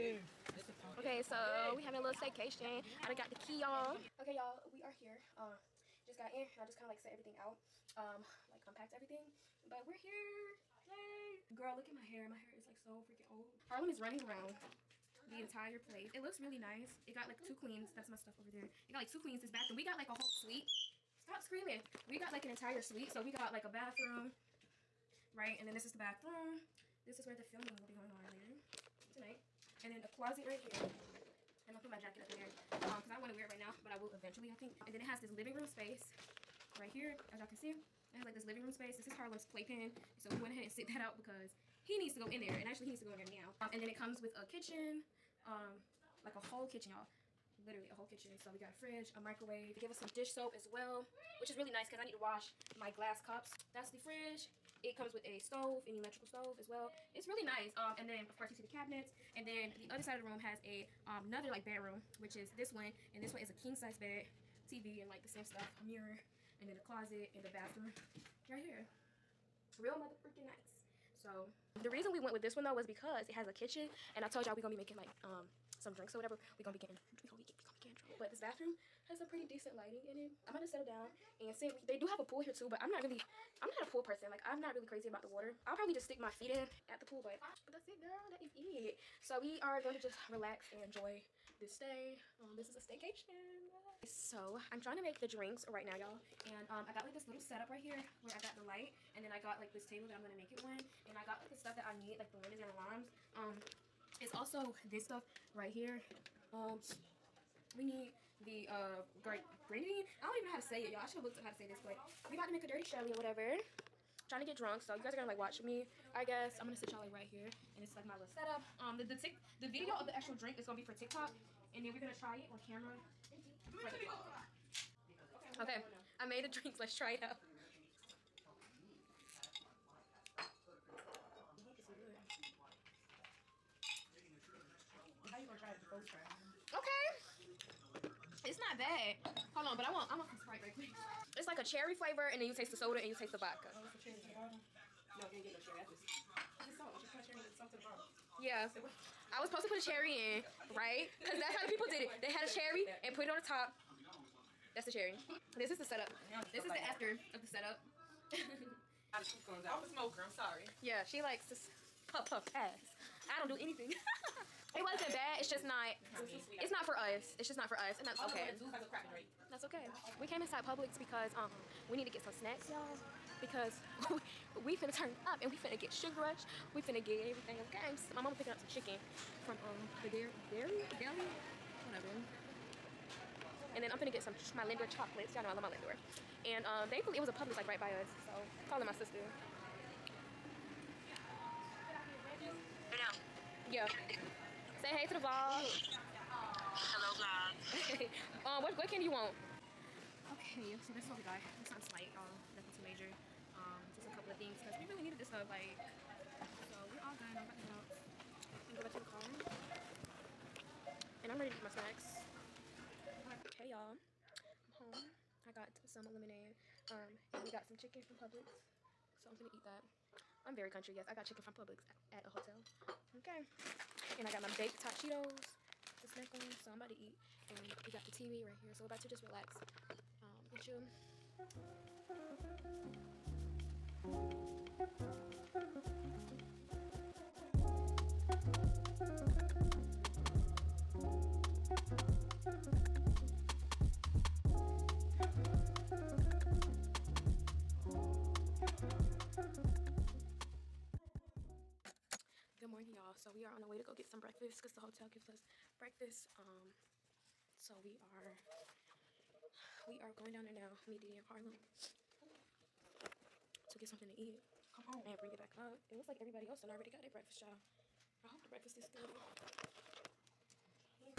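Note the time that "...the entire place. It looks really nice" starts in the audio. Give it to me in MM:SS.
00:15.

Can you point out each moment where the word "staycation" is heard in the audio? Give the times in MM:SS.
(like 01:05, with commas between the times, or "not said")
00:02, 01:32.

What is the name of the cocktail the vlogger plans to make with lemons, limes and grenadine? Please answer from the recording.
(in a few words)
Dirty Shirley.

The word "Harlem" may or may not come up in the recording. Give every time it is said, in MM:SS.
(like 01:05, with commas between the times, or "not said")
00:13, 00:39, 04:21.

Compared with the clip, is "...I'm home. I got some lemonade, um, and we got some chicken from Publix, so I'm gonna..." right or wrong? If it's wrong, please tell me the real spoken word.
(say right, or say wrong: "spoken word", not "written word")
right.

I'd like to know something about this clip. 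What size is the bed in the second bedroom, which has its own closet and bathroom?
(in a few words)
King size.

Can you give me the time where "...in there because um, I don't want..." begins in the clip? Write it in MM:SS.
00:32.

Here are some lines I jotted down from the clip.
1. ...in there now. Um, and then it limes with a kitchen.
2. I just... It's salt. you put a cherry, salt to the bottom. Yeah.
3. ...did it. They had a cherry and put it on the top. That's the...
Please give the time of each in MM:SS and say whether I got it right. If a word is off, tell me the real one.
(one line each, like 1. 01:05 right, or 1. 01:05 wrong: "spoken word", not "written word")
1. 00:43 wrong: "comes", not "limes"
2. 02:25 right
3. 02:31 right.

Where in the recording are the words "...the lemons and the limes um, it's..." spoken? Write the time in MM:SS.
01:42.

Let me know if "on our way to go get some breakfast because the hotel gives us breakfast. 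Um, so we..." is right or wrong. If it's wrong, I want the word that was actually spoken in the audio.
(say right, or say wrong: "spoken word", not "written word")
right.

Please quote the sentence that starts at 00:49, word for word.
They gave us some dish soap as well, which is really nice because I need to wash my glass cups.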